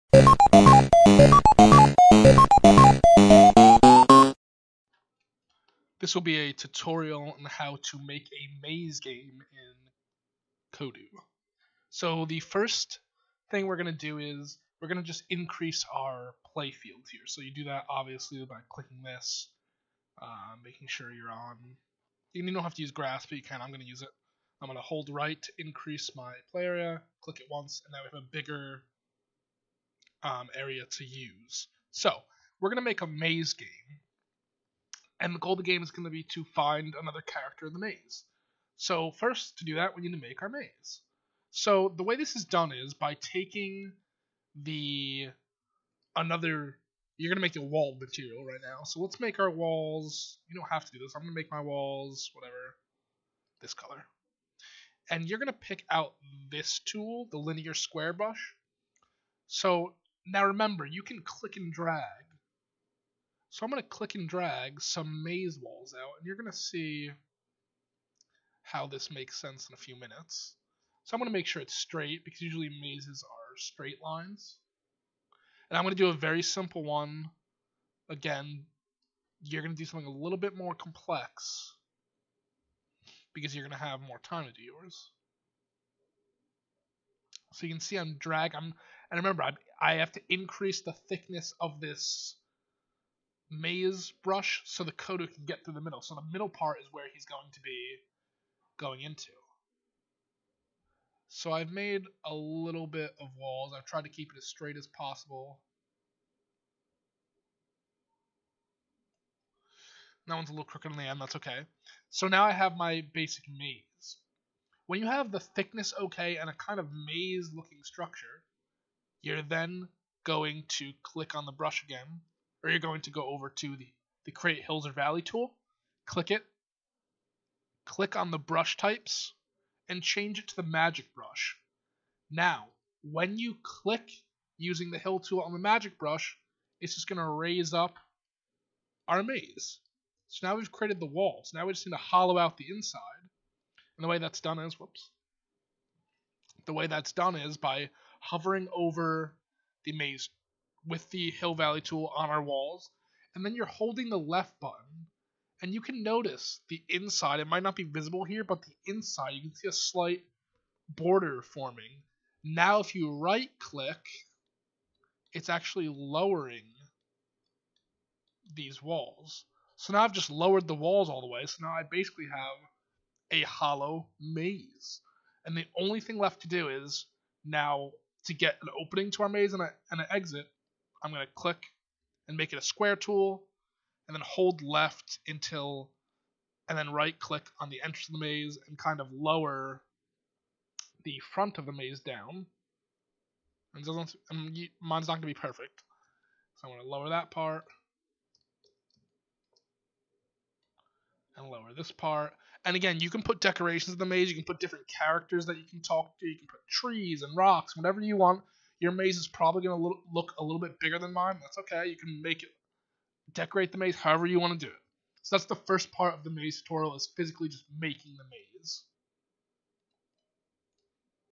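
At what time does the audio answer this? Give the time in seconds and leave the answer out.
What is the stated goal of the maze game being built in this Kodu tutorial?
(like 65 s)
36 s.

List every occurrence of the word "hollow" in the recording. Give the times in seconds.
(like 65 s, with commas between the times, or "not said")
141 s, 173 s.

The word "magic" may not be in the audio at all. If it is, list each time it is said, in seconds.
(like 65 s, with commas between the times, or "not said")
130 s, 135 s.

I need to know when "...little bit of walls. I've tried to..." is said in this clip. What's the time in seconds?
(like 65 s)
102 s.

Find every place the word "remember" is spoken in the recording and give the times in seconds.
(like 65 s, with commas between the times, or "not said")
60 s, 89 s.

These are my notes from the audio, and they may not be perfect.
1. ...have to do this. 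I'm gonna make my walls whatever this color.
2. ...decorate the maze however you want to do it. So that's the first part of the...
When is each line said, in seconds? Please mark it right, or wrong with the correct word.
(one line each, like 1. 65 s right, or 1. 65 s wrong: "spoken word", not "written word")
1. 50 s right
2. 213 s right.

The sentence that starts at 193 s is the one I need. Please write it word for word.
And doesn't, mine's not going to be perfect.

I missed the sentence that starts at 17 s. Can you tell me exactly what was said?
So you do that obviously by clicking this, uh, making sure you're on.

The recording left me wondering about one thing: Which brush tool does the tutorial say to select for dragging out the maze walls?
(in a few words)
linear square brush.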